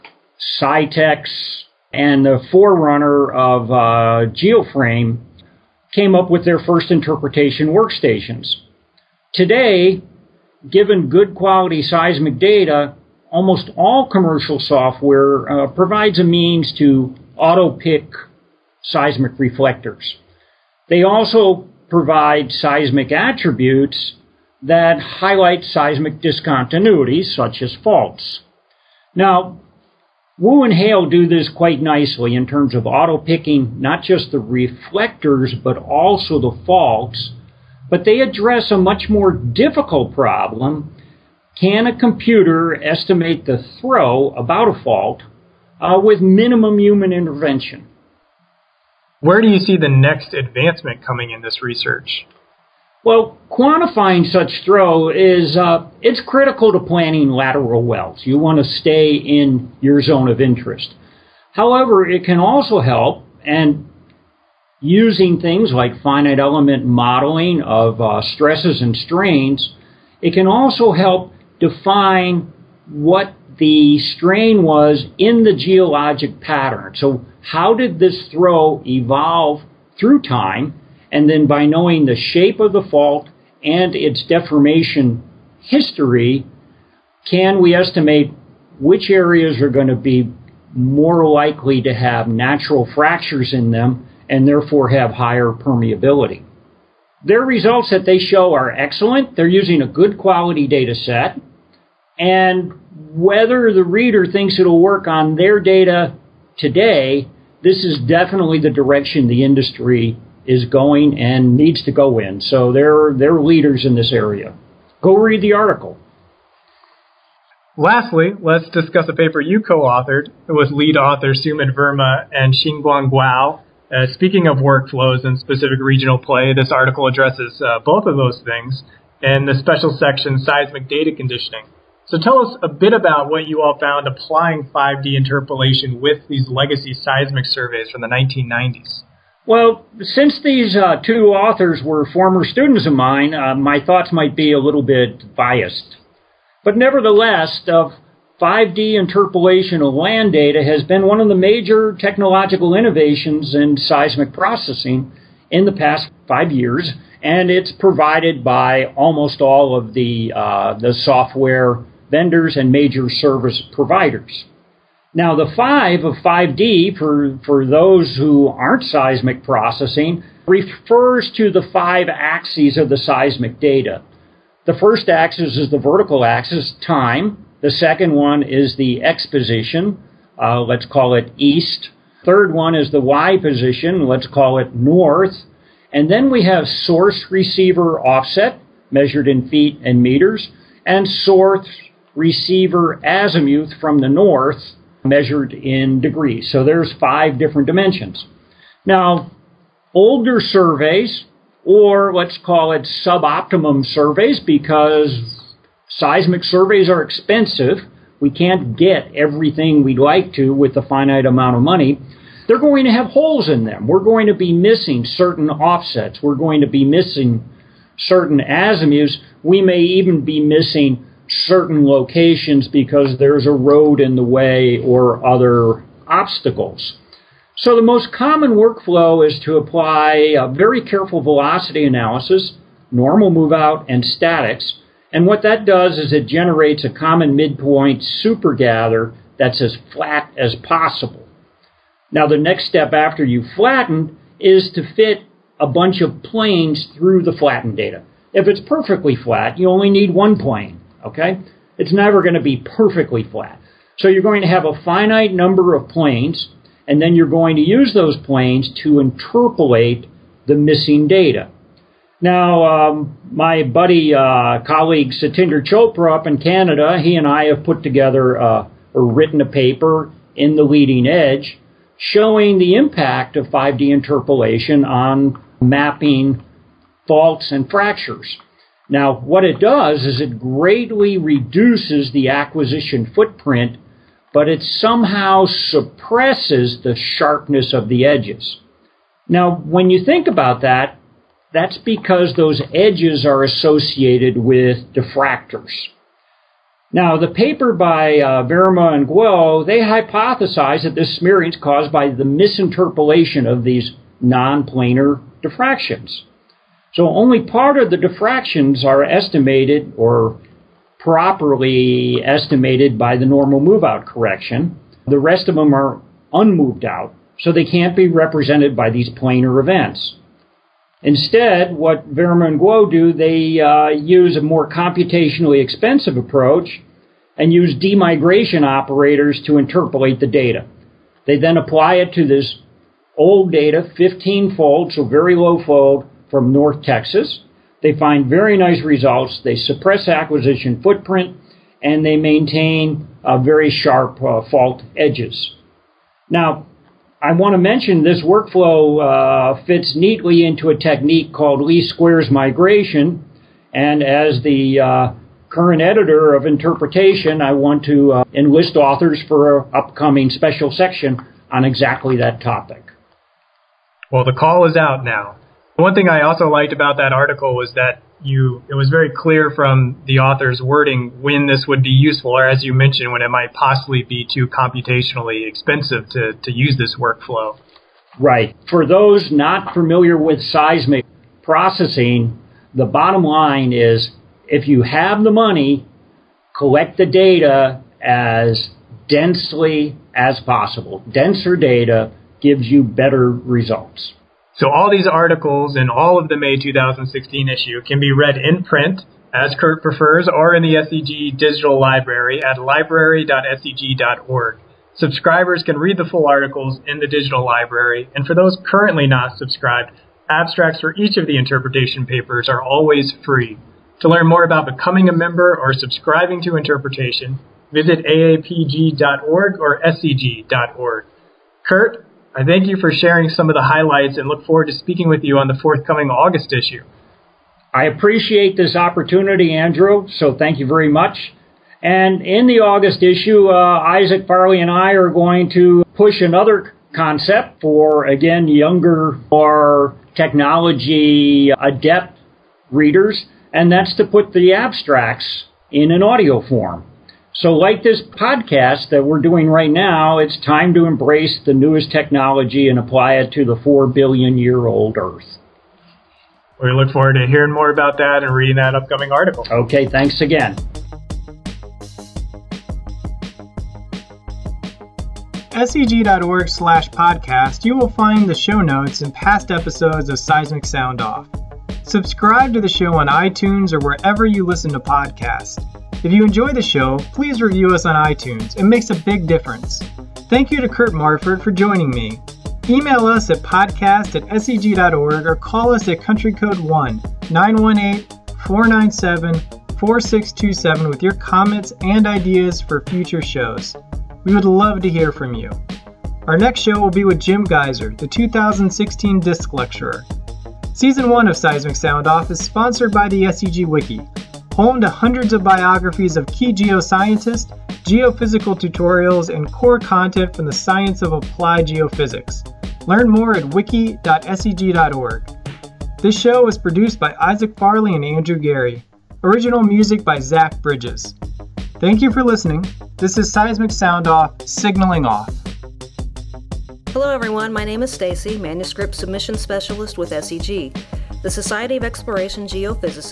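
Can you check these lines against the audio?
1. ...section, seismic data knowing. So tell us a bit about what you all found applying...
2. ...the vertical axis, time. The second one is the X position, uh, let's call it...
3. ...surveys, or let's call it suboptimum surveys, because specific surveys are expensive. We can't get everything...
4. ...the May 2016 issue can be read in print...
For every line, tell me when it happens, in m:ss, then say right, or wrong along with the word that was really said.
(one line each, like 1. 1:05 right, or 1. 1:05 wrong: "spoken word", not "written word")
1. 2:09 wrong: "conditioning", not "knowing"
2. 2:55 right
3. 3:20 wrong: "seismic", not "specific"
4. 6:36 right.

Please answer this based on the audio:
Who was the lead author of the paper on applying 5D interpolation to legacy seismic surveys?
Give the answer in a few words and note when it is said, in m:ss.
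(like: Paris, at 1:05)
Sumit Verma, at 2:01.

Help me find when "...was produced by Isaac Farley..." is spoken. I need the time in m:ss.
8:36.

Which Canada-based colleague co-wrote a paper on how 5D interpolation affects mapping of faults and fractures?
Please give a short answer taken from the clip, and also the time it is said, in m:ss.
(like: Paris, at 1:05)
Satinder Chopra, at 4:25.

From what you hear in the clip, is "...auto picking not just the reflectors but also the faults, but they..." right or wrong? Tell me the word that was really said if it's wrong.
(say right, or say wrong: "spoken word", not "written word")
right.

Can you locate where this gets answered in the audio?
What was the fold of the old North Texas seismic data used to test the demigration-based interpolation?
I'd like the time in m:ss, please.
5:33.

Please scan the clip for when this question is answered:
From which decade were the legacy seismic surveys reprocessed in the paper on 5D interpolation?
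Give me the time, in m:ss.
2:18.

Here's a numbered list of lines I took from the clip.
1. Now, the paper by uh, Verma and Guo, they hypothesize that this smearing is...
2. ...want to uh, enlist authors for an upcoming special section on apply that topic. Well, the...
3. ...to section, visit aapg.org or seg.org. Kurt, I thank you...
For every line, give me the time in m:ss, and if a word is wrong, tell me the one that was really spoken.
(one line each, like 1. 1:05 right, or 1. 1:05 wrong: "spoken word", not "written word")
1. 4:56 right
2. 5:57 wrong: "exactly", not "apply"
3. 6:56 wrong: "interpretation", not "section".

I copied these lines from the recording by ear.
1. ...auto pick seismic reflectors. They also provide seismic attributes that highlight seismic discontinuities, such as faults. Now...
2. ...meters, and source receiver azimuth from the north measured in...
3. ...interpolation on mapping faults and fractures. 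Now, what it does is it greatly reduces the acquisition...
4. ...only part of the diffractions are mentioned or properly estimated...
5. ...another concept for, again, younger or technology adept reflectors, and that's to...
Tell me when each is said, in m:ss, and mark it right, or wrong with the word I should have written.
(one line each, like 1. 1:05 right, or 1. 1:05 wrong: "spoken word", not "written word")
1. 0:17 right
2. 3:10 right
3. 4:33 right
4. 5:07 wrong: "estimated", not "mentioned"
5. 7:16 wrong: "readers", not "reflectors".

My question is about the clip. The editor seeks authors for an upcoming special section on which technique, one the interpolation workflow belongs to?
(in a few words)
Least squares migration.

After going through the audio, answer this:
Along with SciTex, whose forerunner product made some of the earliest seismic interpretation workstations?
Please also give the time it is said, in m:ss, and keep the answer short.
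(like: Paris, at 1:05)
GeoFrame, at 0:04.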